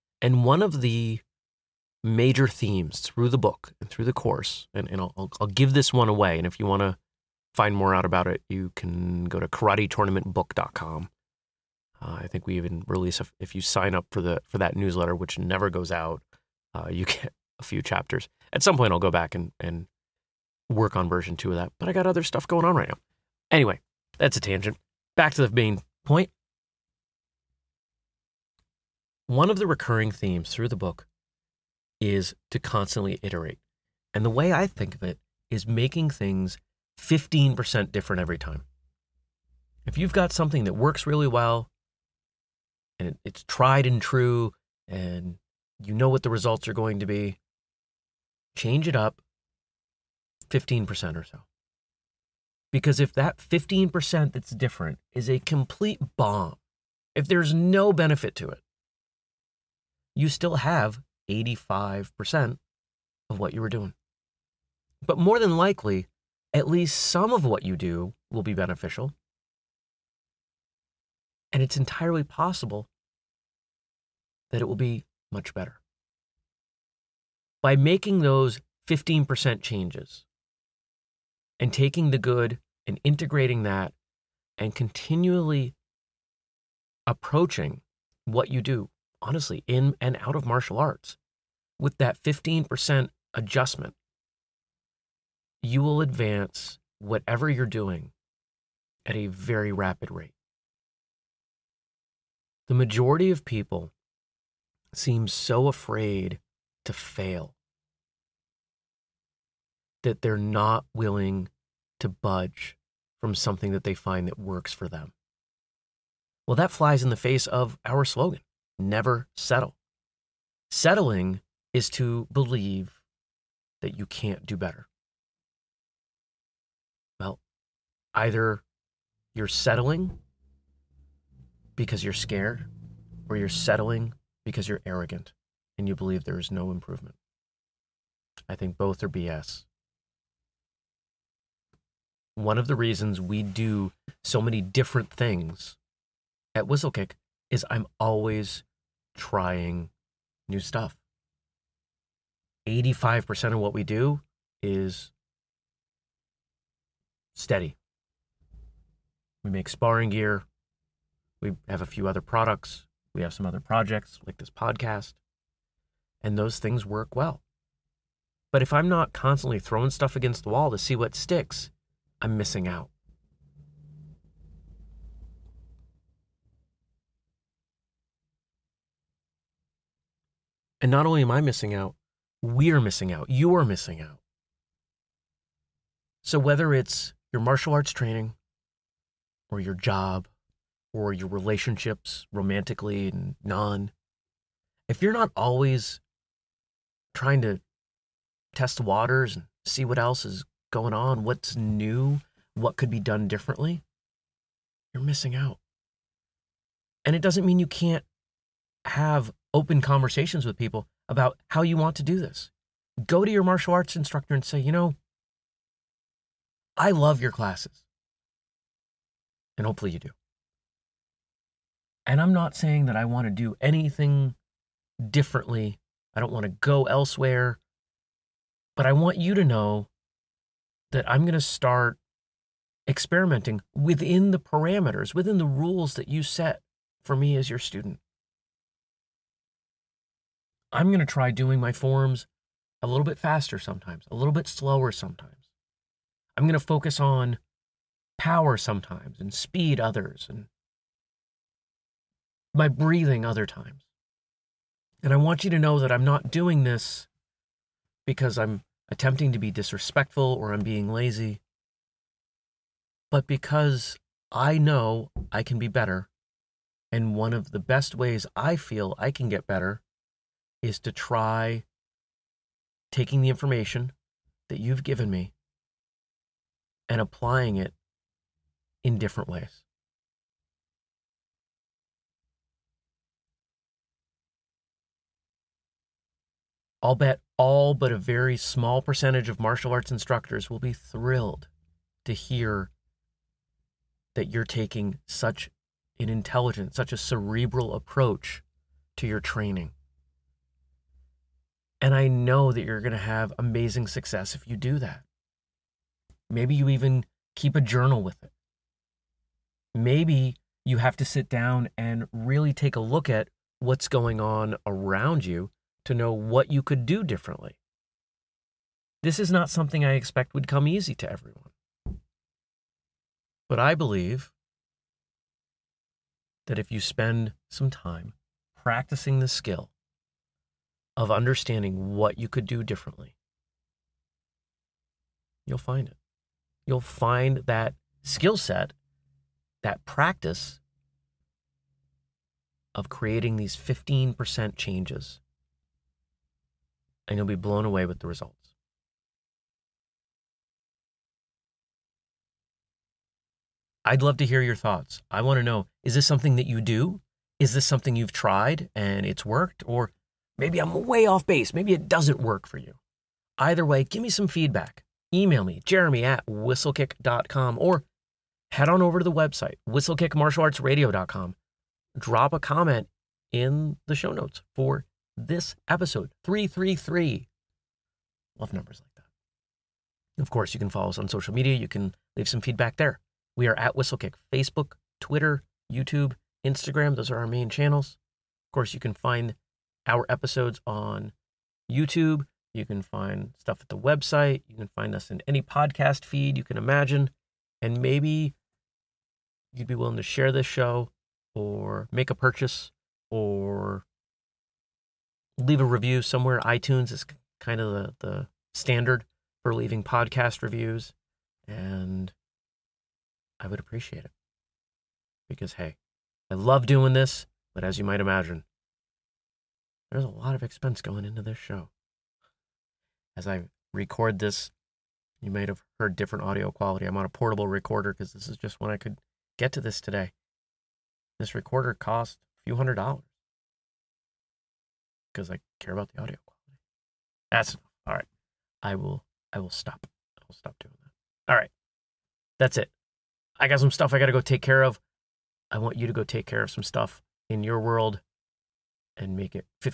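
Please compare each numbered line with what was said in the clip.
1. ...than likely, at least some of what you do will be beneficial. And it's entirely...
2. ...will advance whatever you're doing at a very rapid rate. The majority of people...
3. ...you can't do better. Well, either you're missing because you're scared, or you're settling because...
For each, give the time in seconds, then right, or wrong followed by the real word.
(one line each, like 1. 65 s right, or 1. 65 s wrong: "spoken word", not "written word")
1. 65 s right
2. 95 s right
3. 123 s wrong: "settling", not "missing".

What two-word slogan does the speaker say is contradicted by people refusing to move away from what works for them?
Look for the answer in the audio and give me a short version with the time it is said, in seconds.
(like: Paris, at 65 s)
never settle, at 118 s.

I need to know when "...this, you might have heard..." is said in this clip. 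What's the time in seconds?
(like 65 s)
424 s.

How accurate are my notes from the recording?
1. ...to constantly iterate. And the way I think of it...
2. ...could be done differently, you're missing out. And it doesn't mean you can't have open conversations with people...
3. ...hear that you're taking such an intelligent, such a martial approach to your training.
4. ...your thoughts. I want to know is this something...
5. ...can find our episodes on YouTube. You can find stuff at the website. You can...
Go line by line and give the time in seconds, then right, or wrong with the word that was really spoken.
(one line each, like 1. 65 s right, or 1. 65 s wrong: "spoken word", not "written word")
1. 32 s right
2. 202 s right
3. 292 s wrong: "cerebral", not "martial"
4. 354 s right
5. 388 s right.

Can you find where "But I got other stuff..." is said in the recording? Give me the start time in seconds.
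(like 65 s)
21 s.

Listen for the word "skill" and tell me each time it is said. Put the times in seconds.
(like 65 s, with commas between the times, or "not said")
329 s, 338 s.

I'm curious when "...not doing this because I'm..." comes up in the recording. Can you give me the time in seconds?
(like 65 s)
256 s.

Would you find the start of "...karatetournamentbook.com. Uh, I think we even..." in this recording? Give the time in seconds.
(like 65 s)
9 s.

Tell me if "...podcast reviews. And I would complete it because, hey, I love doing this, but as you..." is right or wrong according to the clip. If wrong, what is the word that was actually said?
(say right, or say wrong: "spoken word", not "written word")
wrong: "appreciate", not "complete".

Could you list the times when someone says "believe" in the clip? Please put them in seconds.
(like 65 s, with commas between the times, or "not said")
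122 s, 135 s, 323 s.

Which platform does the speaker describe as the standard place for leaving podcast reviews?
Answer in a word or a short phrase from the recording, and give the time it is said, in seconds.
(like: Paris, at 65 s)
iTunes, at 406 s.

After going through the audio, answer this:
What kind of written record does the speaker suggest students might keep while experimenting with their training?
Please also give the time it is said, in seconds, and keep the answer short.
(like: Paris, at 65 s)
a journal, at 307 s.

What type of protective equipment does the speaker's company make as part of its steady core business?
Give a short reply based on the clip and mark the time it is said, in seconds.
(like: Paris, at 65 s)
sparring gear, at 159 s.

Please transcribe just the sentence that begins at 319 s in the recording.
This is not something I expect would come easy to everyone.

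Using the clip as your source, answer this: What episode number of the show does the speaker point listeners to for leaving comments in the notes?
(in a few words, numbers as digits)
333.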